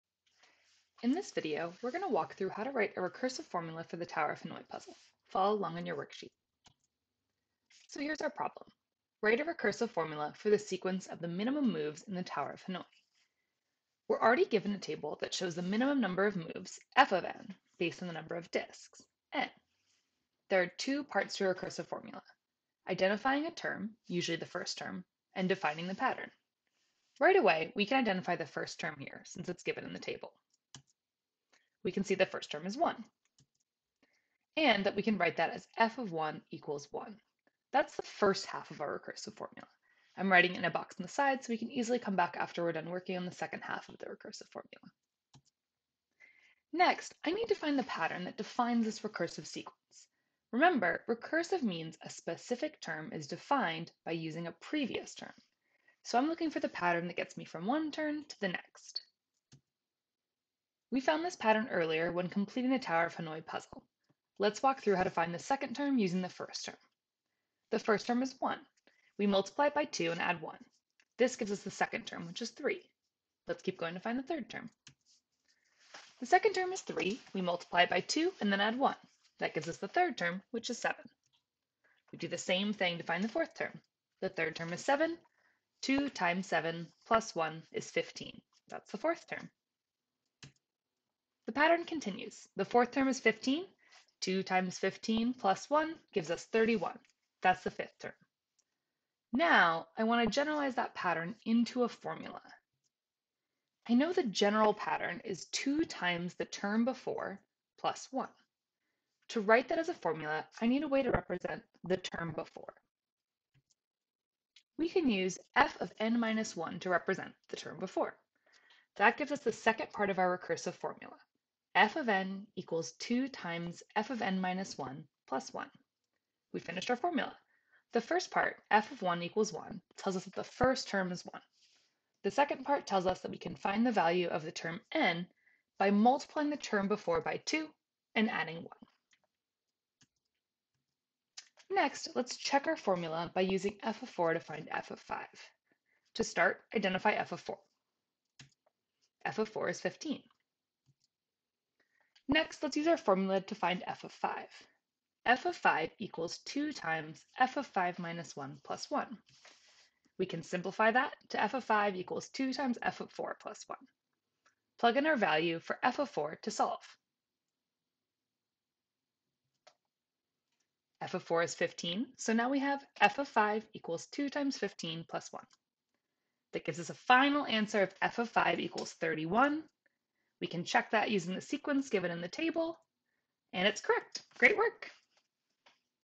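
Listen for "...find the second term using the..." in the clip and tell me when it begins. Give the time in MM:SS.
01:05.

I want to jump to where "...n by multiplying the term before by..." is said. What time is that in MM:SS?
02:14.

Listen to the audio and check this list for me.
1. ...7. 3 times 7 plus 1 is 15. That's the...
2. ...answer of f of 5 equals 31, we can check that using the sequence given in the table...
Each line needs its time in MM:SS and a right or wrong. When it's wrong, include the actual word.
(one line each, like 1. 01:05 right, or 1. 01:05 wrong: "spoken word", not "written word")
1. 01:24 wrong: "2", not "3"
2. 02:57 right.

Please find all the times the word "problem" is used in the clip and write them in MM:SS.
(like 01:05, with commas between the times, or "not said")
00:08.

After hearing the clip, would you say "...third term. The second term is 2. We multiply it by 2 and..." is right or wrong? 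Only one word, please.
wrong.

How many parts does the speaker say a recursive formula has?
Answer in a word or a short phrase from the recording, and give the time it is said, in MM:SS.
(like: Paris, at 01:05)
2, at 00:20.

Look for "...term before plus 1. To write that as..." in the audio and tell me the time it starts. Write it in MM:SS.
01:46.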